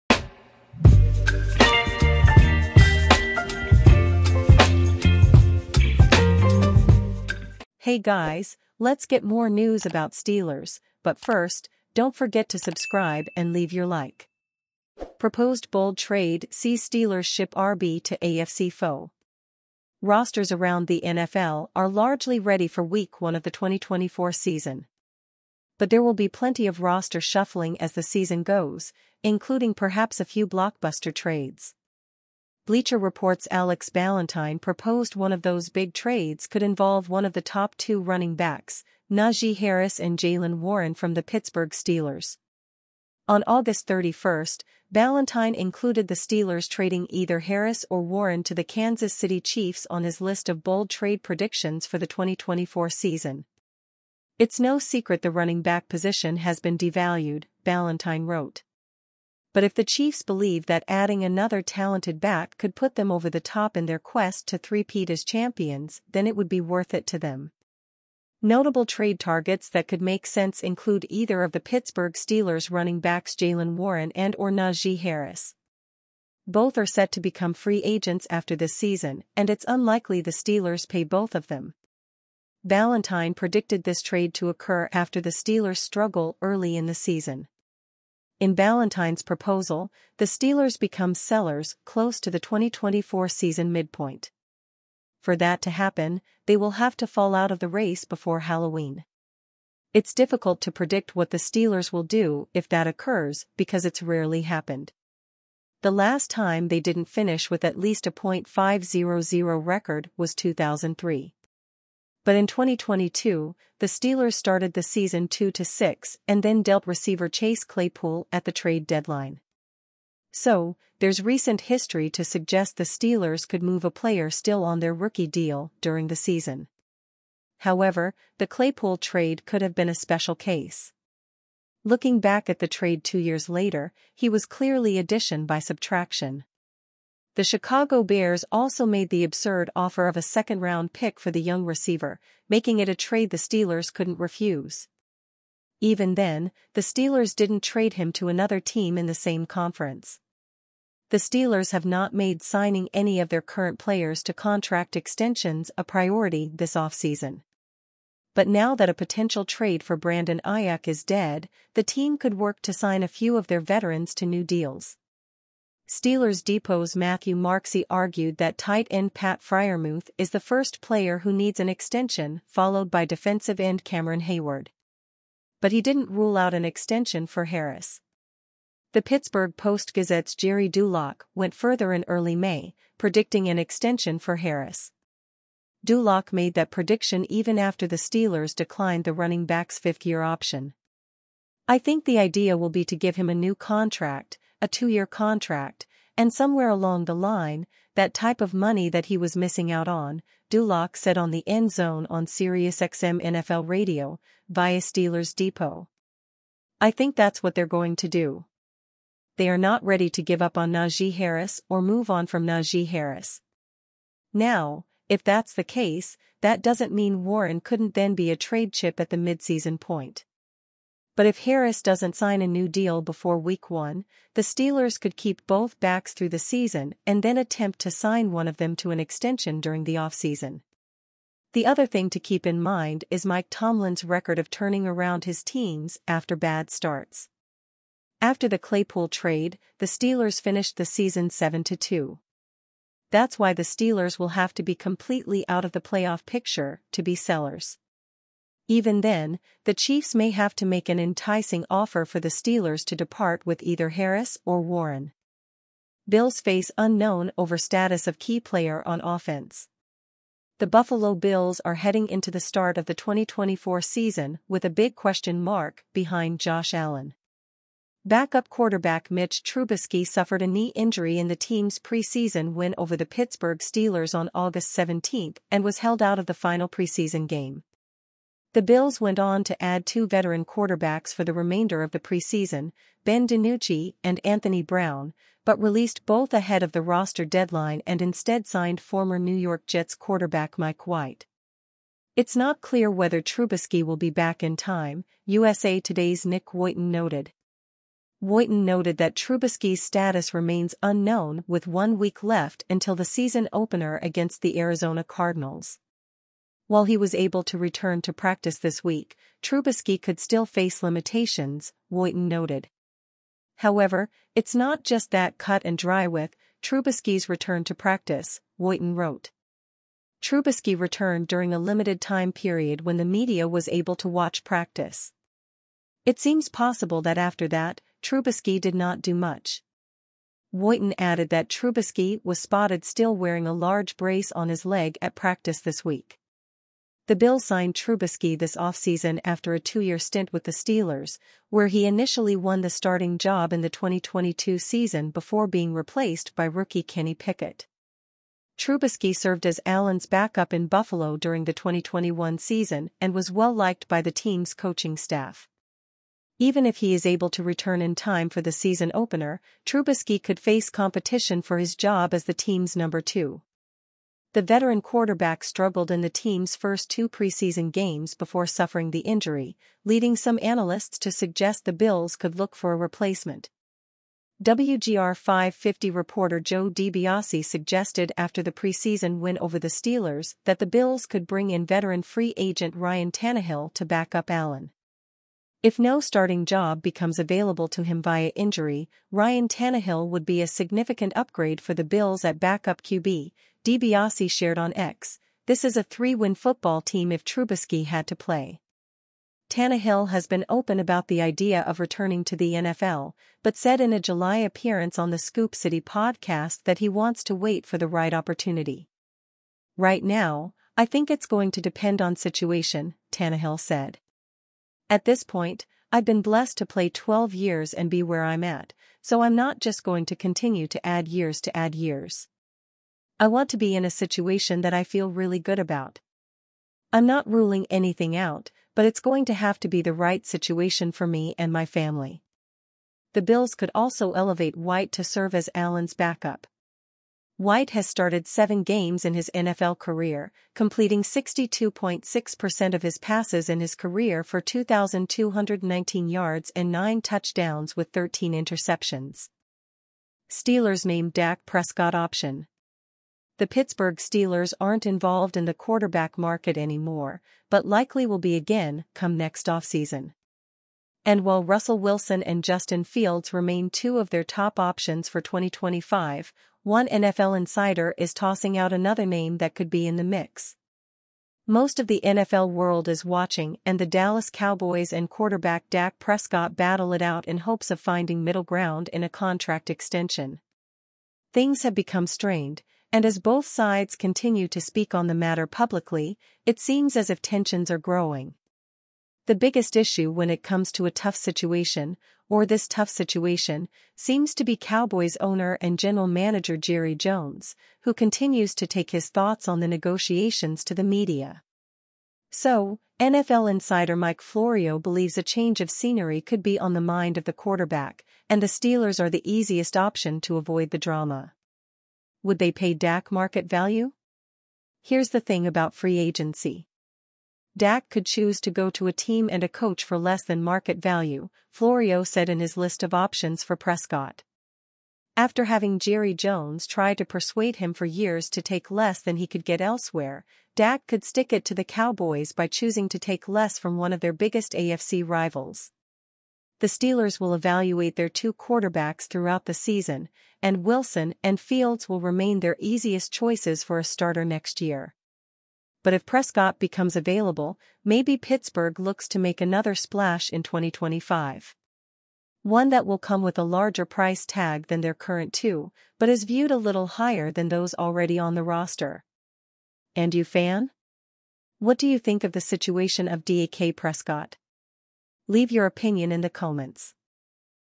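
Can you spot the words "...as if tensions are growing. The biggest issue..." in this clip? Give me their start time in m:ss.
8:06.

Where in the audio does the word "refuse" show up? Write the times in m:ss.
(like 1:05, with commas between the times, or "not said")
2:24.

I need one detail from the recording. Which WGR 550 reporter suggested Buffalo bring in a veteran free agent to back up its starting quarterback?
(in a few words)
Joe DiBiase.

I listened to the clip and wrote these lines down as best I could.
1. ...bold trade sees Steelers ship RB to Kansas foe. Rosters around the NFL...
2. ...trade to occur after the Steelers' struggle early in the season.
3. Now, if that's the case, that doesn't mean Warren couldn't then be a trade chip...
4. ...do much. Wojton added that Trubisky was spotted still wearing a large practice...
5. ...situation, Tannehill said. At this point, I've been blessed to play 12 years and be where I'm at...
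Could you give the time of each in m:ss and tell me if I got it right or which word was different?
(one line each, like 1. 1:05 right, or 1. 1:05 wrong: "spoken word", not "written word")
1. 0:15 wrong: "AFC", not "Kansas"
2. 1:24 right
3. 3:34 right
4. 5:29 wrong: "brace", not "practice"
5. 6:52 right.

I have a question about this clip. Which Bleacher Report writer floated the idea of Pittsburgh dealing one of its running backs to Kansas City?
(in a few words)
Alex Ballentine.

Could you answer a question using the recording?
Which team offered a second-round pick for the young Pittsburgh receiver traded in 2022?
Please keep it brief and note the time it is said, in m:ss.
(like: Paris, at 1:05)
Chicago Bears, at 2:17.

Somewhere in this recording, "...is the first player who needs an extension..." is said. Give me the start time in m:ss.
2:50.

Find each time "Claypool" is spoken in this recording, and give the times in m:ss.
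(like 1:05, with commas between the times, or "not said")
1:57, 2:08, 3:58.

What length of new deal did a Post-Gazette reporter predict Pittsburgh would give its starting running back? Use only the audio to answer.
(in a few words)
two-year contract.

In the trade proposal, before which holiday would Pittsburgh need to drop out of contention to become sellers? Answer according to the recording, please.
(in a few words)
Halloween.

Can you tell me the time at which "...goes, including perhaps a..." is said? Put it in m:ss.
0:28.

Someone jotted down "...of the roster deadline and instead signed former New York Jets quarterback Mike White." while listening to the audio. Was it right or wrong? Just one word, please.
right.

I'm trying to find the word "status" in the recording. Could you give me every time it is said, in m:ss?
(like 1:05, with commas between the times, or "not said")
4:17, 4:59.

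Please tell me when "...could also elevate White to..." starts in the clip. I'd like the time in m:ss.
7:13.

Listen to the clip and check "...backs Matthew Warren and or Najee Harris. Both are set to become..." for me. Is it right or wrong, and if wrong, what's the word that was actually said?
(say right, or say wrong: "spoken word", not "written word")
wrong: "Jaylen", not "Matthew".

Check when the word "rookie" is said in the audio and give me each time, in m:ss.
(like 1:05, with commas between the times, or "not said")
2:04, 5:46.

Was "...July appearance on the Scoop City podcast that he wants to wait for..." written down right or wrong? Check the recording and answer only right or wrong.
right.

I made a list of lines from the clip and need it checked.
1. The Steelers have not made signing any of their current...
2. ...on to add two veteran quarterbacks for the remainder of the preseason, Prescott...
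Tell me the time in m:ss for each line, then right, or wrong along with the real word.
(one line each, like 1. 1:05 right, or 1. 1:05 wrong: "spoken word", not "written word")
1. 2:31 right
2. 4:39 wrong: "Ben", not "Prescott".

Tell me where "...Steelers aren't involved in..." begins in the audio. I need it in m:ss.
7:33.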